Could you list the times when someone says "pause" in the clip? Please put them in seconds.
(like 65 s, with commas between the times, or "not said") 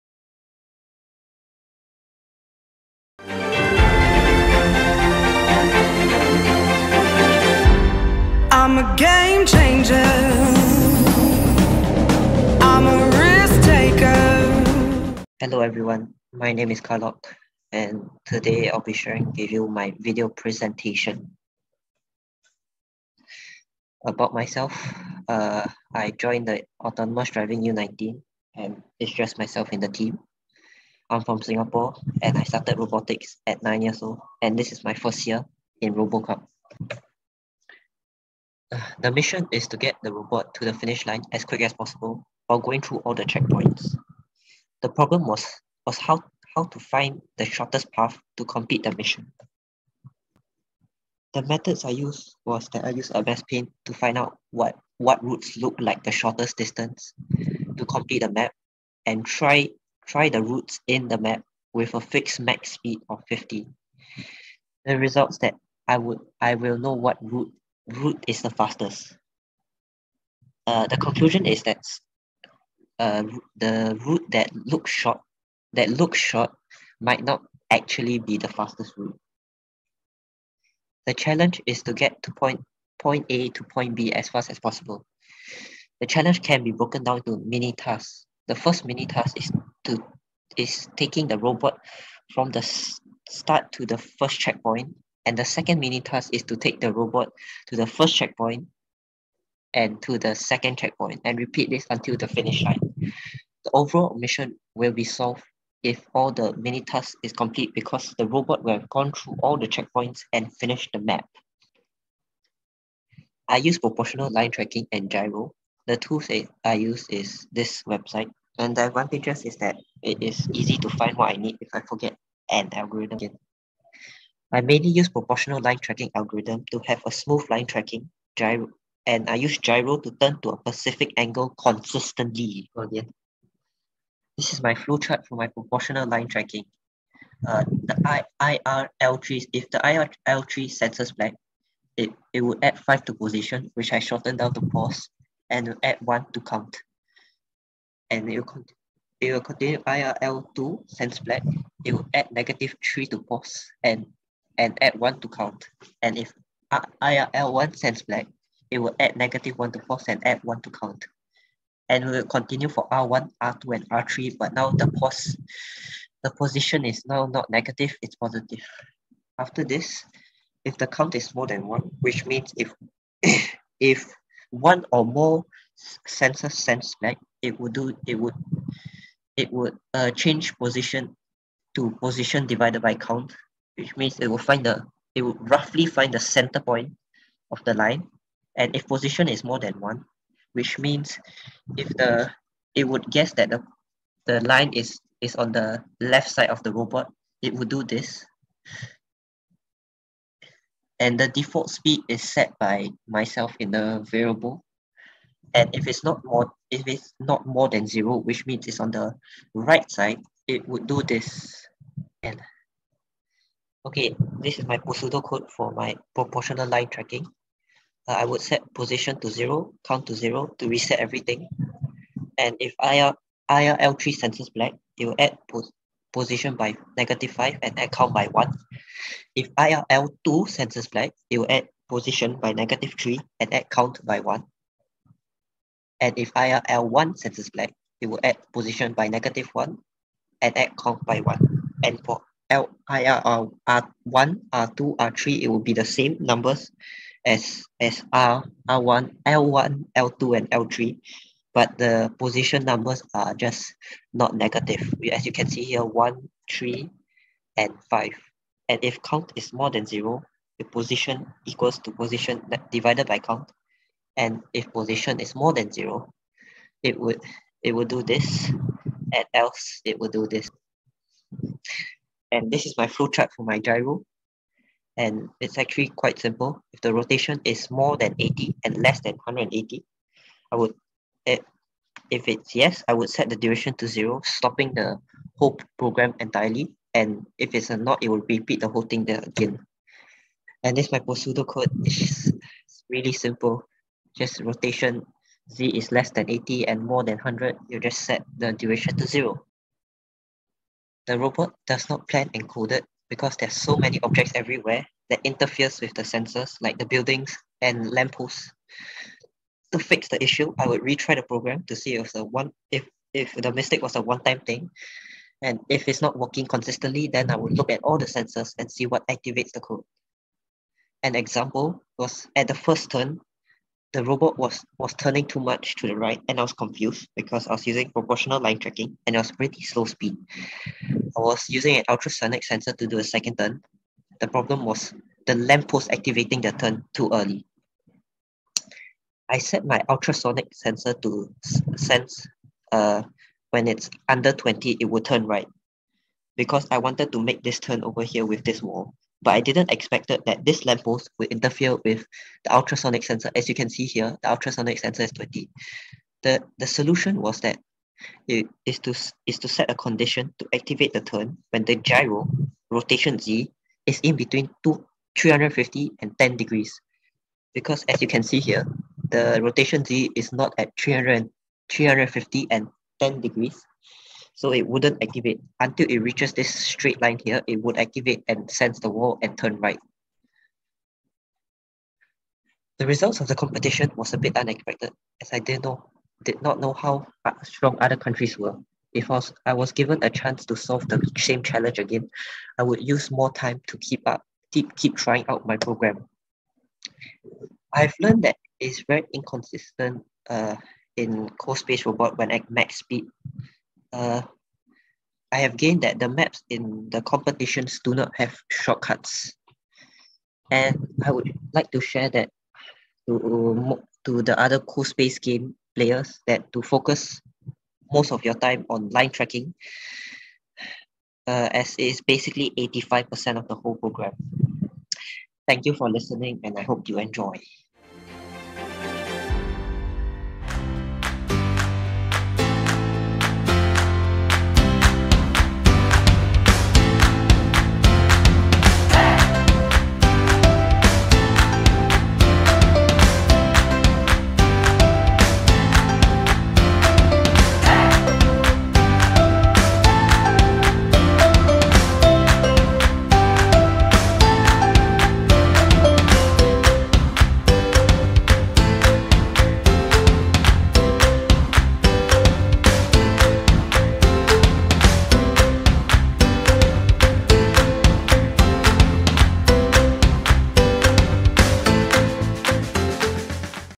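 144 s, 153 s, 159 s.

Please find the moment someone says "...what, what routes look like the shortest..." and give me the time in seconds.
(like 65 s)
54 s.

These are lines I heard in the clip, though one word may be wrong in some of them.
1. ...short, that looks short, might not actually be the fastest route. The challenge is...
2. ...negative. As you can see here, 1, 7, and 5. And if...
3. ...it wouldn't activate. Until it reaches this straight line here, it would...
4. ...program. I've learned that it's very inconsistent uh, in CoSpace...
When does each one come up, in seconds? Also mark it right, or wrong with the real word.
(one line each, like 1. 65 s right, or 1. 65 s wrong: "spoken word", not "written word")
1. 74 s right
2. 254 s wrong: "3", not "7"
3. 374 s right
4. 395 s right.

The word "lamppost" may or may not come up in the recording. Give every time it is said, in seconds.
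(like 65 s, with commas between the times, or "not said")
307 s, 335 s, 350 s.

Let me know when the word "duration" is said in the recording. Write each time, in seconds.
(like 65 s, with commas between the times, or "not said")
283 s, 298 s.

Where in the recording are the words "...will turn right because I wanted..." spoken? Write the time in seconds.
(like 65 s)
344 s.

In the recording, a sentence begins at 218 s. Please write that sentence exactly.
Uh, I would set position to zero, count to zero to reset everything.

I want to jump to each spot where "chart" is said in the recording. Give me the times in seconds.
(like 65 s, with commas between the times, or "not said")
134 s, 273 s.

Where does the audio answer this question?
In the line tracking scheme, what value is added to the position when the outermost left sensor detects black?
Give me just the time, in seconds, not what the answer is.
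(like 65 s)
225 s.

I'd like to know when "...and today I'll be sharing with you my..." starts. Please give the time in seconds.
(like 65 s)
17 s.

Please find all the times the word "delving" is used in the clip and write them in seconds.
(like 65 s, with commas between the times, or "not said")
not said.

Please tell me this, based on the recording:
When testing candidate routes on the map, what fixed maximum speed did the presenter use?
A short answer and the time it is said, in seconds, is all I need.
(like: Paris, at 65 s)
50, at 61 s.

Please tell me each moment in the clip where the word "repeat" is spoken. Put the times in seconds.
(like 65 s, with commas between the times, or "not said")
101 s, 288 s.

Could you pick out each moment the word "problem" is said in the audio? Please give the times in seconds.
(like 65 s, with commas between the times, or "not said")
44 s, 334 s.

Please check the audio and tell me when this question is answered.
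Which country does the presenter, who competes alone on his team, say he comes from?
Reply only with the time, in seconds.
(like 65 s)
31 s.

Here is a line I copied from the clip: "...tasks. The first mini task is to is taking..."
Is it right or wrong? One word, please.
right.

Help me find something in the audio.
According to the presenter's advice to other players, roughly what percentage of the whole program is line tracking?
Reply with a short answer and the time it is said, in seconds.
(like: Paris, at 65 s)
85%, at 422 s.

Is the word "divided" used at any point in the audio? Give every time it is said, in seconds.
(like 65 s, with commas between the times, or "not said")
182 s, 262 s.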